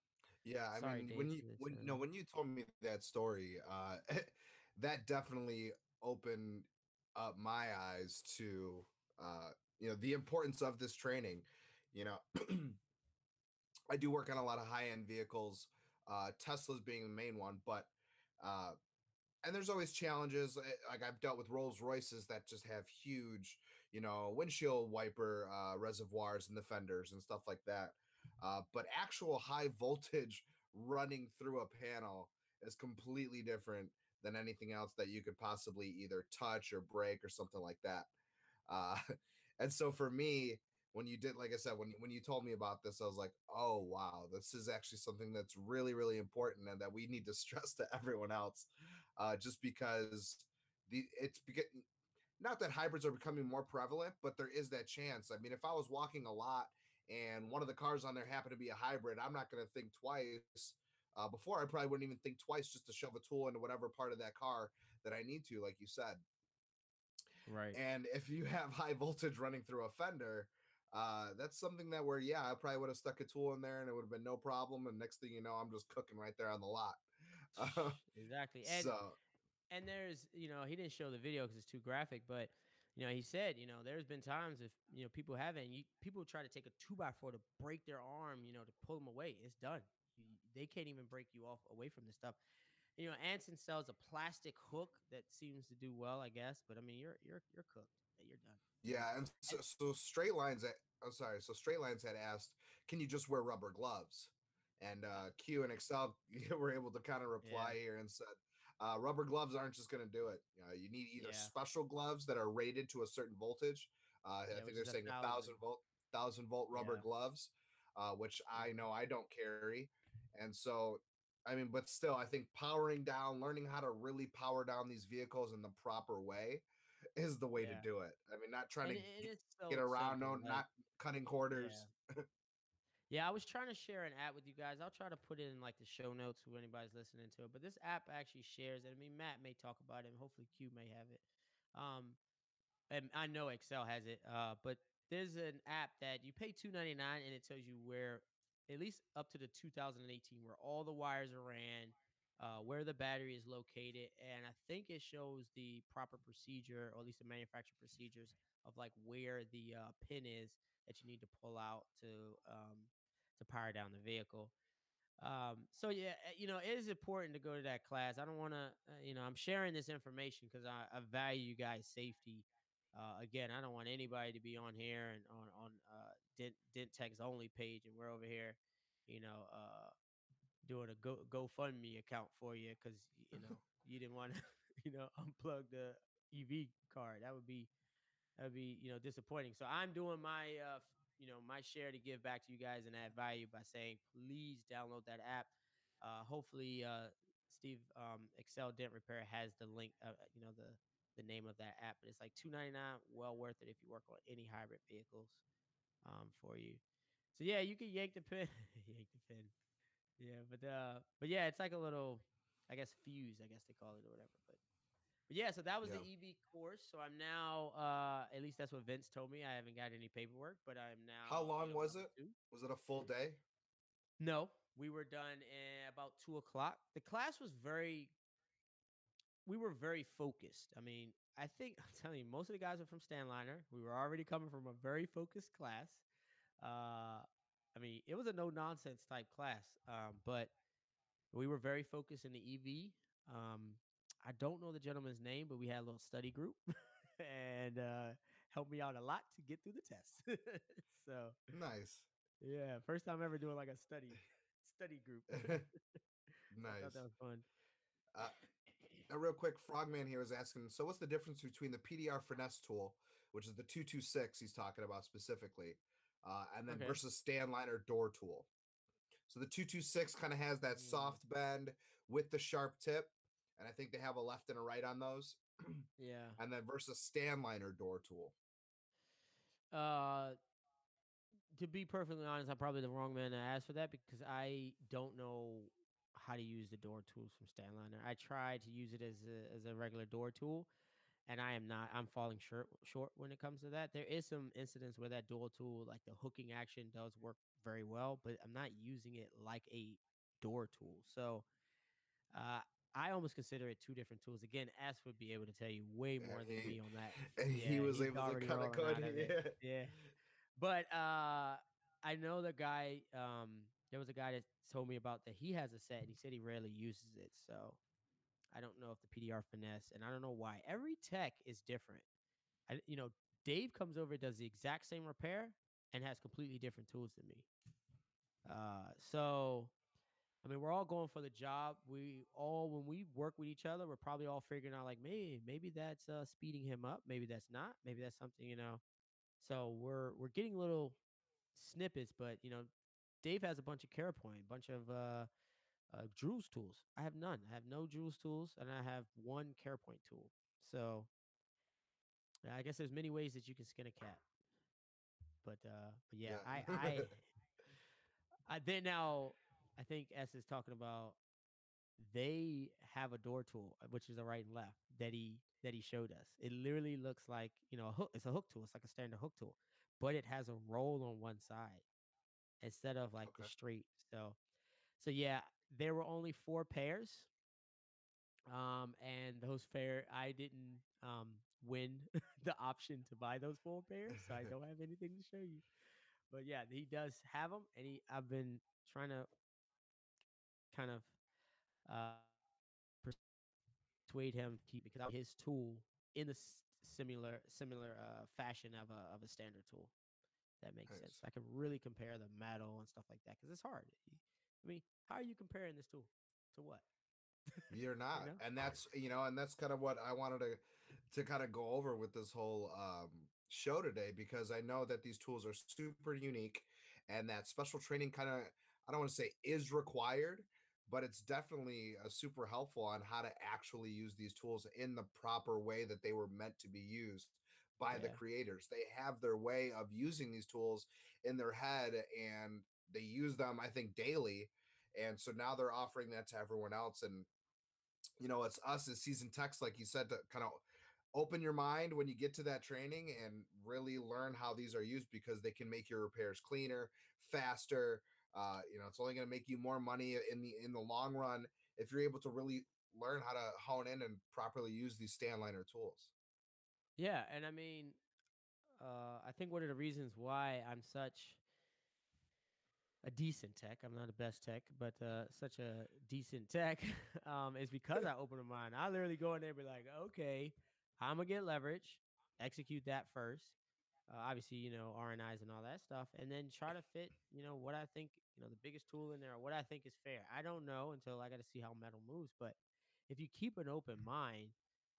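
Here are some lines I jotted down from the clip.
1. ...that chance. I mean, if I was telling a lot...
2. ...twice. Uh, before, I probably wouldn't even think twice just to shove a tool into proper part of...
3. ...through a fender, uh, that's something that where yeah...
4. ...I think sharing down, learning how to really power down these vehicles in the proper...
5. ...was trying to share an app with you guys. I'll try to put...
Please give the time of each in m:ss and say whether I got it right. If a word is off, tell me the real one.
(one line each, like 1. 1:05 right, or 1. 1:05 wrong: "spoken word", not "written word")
1. 0:54 wrong: "walking", not "telling"
2. 0:59 wrong: "whatever", not "proper"
3. 1:09 right
4. 2:02 wrong: "powering", not "sharing"
5. 2:13 right.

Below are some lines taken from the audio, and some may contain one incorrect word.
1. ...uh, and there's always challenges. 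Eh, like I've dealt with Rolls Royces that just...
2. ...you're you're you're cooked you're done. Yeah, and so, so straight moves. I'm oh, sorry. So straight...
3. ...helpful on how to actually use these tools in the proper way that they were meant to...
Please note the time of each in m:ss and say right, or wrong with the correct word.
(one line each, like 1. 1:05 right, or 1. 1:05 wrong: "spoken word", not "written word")
1. 0:18 right
2. 1:36 wrong: "lines", not "moves"
3. 7:02 right.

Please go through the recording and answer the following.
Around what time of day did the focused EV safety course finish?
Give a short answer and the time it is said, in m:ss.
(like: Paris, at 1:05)
2 o'clock, at 3:46.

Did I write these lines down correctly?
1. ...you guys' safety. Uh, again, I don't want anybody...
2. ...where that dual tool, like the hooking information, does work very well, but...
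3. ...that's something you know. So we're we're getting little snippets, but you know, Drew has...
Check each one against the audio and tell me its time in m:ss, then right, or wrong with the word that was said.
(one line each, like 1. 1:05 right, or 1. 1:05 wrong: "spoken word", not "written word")
1. 2:51 right
2. 4:54 wrong: "action", not "information"
3. 5:38 wrong: "Dave", not "Drew".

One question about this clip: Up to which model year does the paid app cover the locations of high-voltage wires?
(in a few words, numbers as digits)
2018.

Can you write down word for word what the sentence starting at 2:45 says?
Um, so yeah, eh, you know, it is important to go to that class.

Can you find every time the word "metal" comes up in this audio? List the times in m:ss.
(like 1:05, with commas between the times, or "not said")
6:42, 8:01.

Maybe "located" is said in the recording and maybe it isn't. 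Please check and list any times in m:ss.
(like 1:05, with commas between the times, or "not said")
2:33.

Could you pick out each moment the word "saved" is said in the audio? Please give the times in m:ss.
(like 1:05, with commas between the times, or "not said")
not said.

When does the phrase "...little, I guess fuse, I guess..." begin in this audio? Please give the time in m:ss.
3:31.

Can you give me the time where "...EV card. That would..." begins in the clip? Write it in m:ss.
3:06.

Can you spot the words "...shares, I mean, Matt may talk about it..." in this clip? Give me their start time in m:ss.
2:18.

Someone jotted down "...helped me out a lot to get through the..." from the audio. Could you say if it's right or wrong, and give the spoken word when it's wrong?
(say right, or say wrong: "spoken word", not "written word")
right.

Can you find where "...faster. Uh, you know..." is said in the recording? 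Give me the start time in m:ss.
7:27.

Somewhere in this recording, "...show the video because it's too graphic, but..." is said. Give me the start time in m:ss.
1:20.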